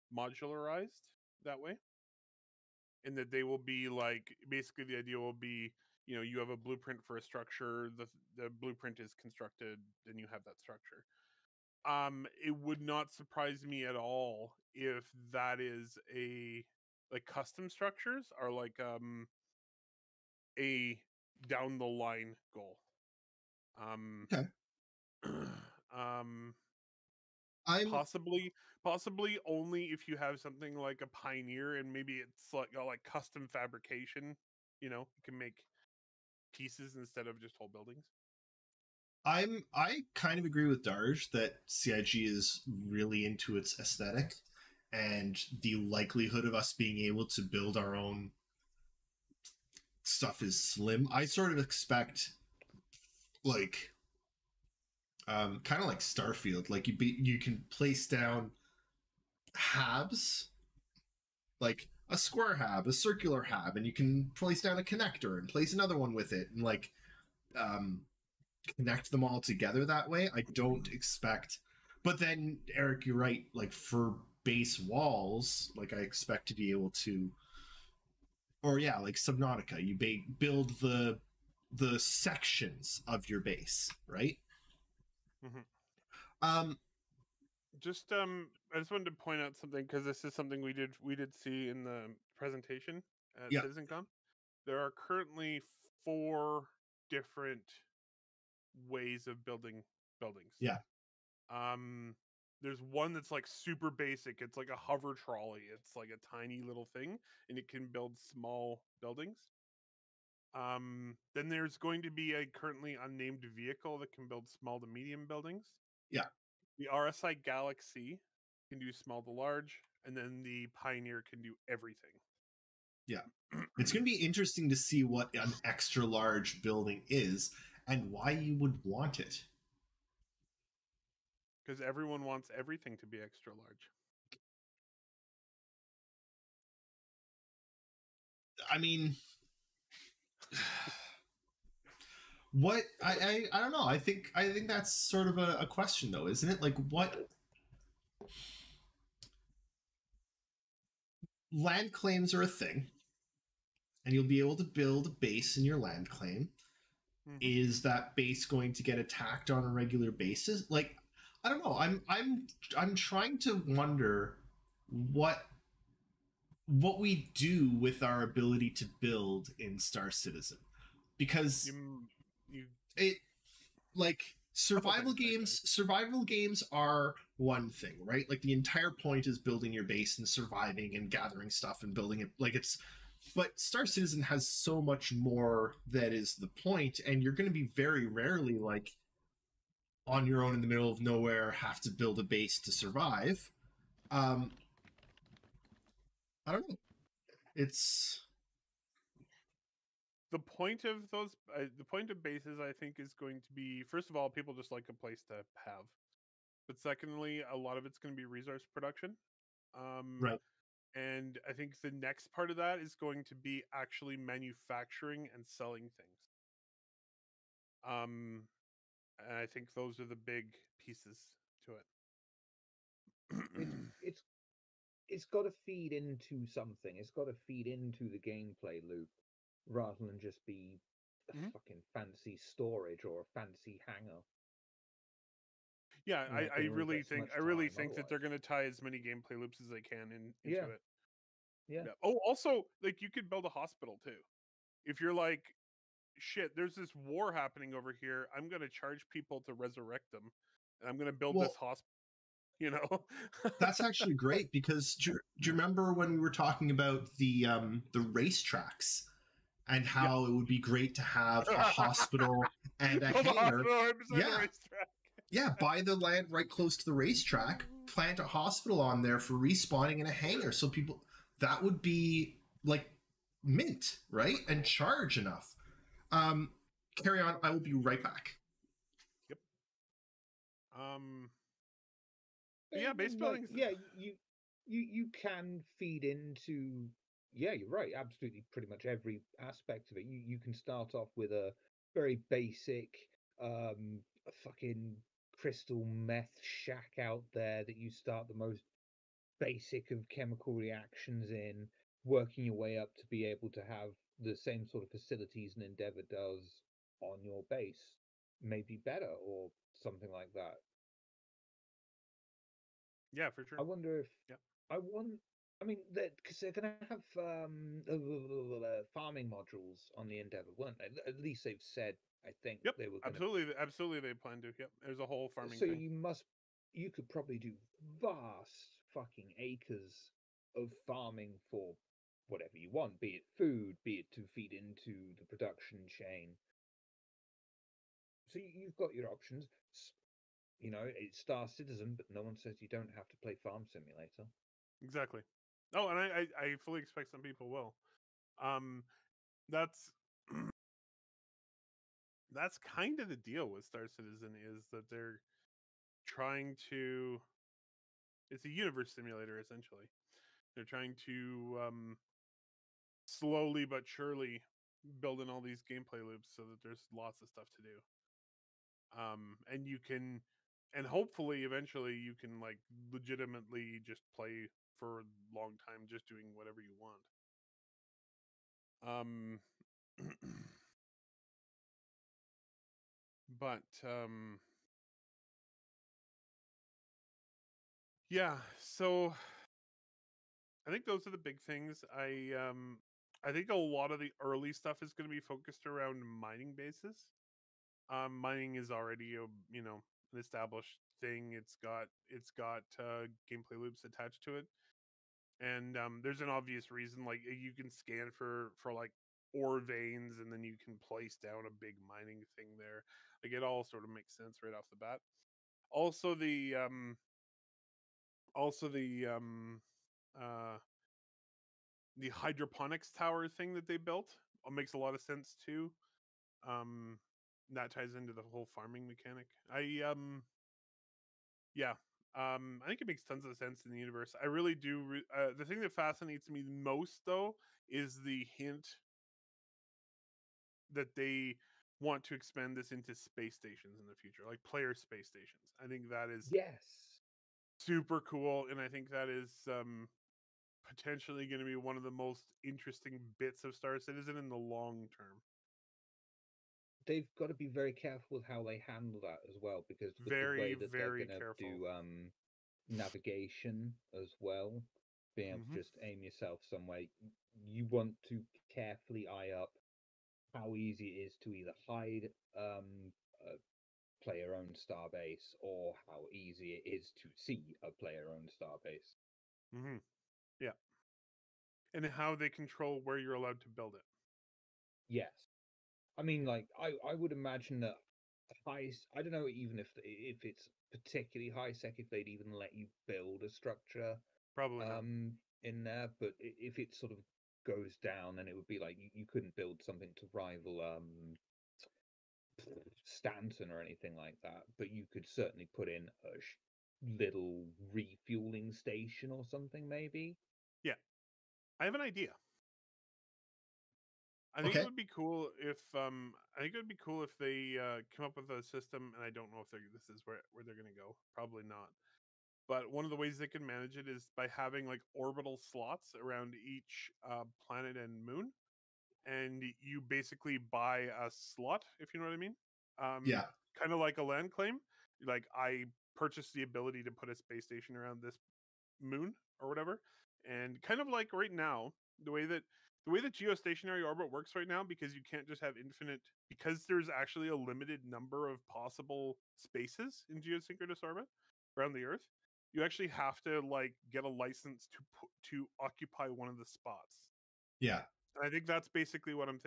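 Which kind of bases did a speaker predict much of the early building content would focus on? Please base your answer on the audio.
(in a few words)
Mining bases.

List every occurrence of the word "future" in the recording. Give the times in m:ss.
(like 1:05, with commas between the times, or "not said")
7:23.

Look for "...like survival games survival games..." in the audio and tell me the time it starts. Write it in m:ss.
2:53.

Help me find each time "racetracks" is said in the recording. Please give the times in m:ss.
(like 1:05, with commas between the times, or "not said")
4:17, 4:26.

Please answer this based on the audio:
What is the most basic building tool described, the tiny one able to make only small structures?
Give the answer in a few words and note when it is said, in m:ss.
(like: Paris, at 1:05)
A hover trolley, at 1:44.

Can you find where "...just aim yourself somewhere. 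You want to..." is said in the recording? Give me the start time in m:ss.
7:45.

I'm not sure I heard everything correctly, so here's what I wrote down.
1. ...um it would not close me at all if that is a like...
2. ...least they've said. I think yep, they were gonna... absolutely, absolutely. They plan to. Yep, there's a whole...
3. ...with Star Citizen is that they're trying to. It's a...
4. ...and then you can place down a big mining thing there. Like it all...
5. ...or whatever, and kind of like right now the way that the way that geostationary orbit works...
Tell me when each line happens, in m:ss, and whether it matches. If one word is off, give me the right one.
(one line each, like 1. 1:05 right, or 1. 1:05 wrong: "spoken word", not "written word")
1. 0:11 wrong: "surprise", not "close"
2. 5:21 right
3. 5:53 right
4. 6:50 right
5. 8:59 right.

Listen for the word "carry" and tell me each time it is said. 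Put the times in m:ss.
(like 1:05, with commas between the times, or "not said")
4:36.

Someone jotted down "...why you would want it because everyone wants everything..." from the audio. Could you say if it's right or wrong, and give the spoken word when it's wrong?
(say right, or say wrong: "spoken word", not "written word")
right.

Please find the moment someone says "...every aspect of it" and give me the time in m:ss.
4:48.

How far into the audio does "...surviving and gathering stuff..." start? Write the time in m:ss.
3:00.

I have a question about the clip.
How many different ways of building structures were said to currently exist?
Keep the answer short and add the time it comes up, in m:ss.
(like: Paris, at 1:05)
4, at 1:36.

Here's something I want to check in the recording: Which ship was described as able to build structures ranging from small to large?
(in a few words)
RSI Galaxy.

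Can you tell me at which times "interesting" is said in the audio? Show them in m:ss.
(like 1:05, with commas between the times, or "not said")
2:04, 7:32.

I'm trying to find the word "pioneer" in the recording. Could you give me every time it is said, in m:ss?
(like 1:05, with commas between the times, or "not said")
0:31, 2:00.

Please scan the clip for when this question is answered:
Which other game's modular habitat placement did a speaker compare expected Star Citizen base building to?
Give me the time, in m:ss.
0:55.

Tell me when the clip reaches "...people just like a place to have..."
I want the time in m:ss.
3:24.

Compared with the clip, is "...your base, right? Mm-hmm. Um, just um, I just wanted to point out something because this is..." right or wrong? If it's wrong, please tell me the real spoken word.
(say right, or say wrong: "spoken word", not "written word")
right.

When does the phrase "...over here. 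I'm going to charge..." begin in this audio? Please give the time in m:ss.
4:07.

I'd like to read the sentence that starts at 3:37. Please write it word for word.
Um, and I think those are the big pieces to it.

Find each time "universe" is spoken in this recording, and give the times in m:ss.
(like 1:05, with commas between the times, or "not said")
5:58, 7:13.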